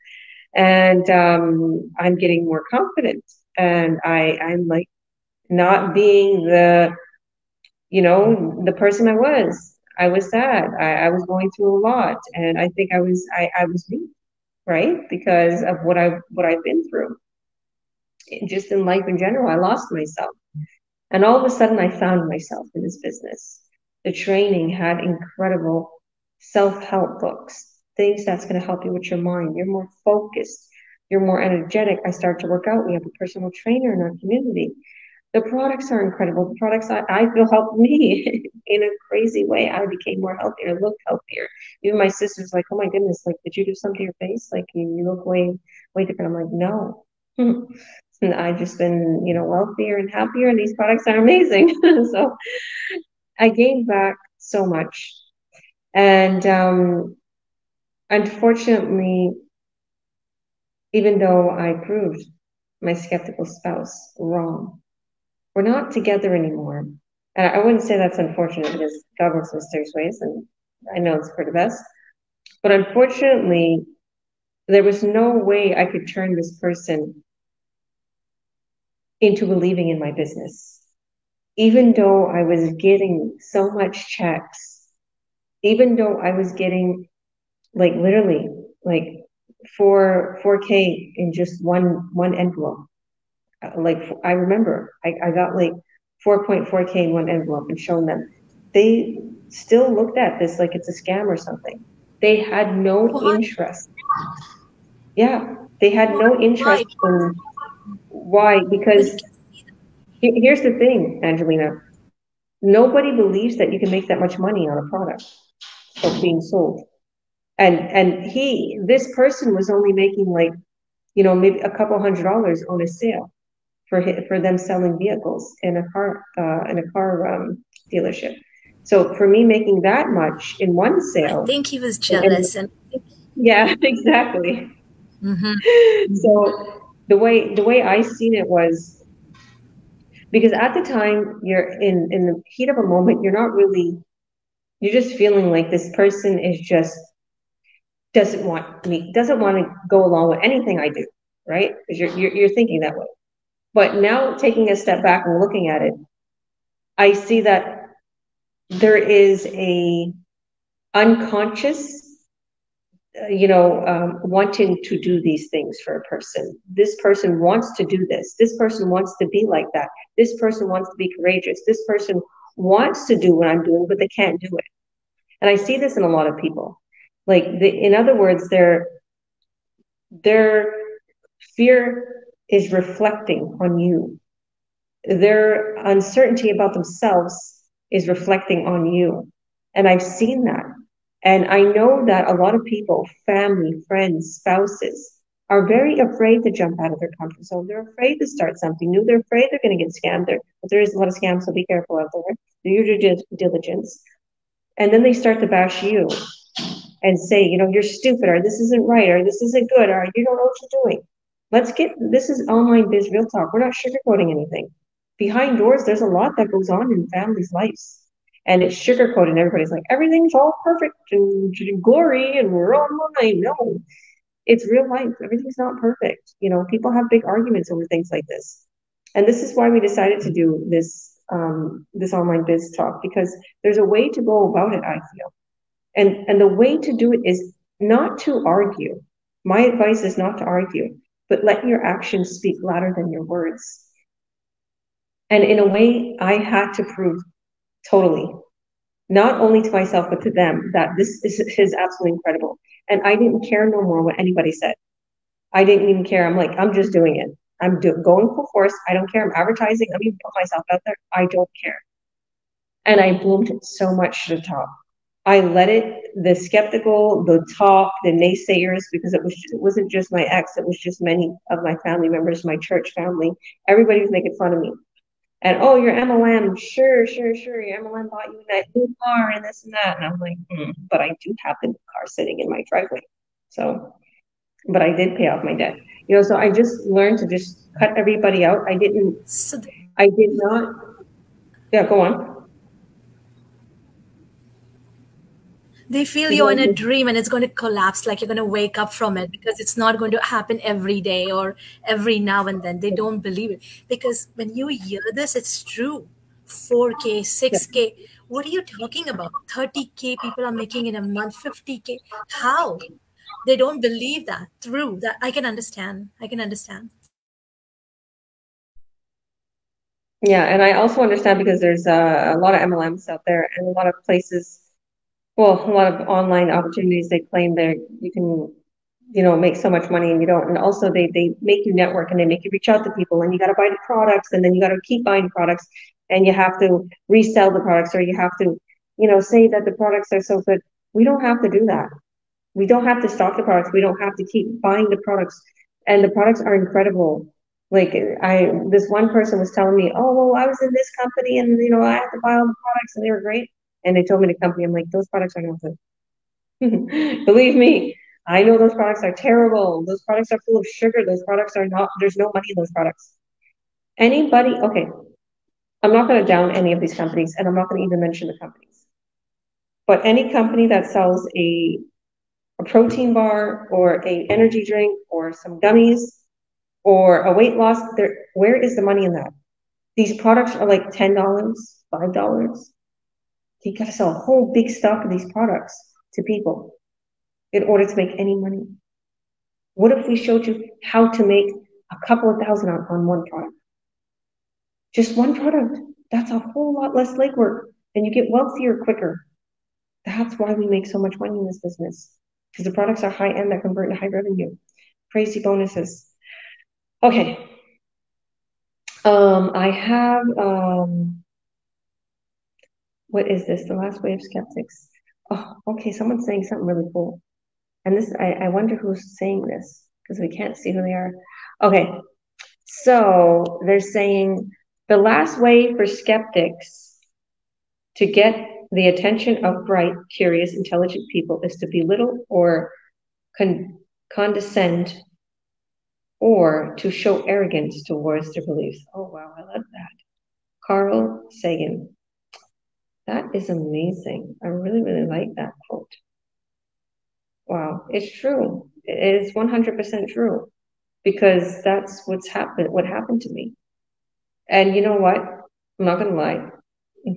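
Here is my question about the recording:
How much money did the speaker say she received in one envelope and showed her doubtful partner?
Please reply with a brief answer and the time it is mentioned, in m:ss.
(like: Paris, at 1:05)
4.4k, at 1:36.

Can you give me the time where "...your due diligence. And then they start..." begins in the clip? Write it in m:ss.
3:22.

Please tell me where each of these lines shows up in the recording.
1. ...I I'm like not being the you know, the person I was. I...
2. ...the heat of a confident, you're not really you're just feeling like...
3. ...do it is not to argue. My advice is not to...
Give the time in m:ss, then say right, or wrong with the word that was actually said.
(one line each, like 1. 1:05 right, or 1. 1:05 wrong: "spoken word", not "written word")
1. 0:04 right
2. 2:22 wrong: "moment", not "confident"
3. 3:56 right.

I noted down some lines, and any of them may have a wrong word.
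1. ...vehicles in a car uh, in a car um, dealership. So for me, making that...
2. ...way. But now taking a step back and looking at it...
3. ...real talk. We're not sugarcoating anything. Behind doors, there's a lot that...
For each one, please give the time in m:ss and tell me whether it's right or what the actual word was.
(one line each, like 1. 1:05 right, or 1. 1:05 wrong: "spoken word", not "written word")
1. 2:04 right
2. 2:32 right
3. 3:33 right.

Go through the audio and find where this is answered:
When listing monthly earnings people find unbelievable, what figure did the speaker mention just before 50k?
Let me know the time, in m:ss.
5:09.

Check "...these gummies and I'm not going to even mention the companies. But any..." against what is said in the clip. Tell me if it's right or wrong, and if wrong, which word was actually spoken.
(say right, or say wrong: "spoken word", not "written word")
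wrong: "companies", not "gummies".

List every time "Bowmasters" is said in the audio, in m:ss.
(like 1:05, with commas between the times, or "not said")
not said.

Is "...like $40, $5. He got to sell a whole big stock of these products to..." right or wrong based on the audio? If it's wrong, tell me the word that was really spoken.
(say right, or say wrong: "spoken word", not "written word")
wrong: "10", not "40".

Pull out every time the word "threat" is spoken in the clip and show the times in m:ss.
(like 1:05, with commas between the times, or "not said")
not said.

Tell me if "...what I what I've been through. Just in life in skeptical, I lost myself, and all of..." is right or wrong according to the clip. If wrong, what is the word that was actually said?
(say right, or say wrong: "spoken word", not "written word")
wrong: "general", not "skeptical".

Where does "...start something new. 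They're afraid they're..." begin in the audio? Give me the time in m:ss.
3:18.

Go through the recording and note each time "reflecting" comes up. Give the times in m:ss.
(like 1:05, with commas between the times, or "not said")
3:02, 3:08.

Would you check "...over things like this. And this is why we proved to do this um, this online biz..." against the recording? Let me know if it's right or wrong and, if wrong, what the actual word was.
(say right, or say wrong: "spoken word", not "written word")
wrong: "decided", not "proved".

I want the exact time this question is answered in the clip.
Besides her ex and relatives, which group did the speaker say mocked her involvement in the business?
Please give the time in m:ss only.
4:32.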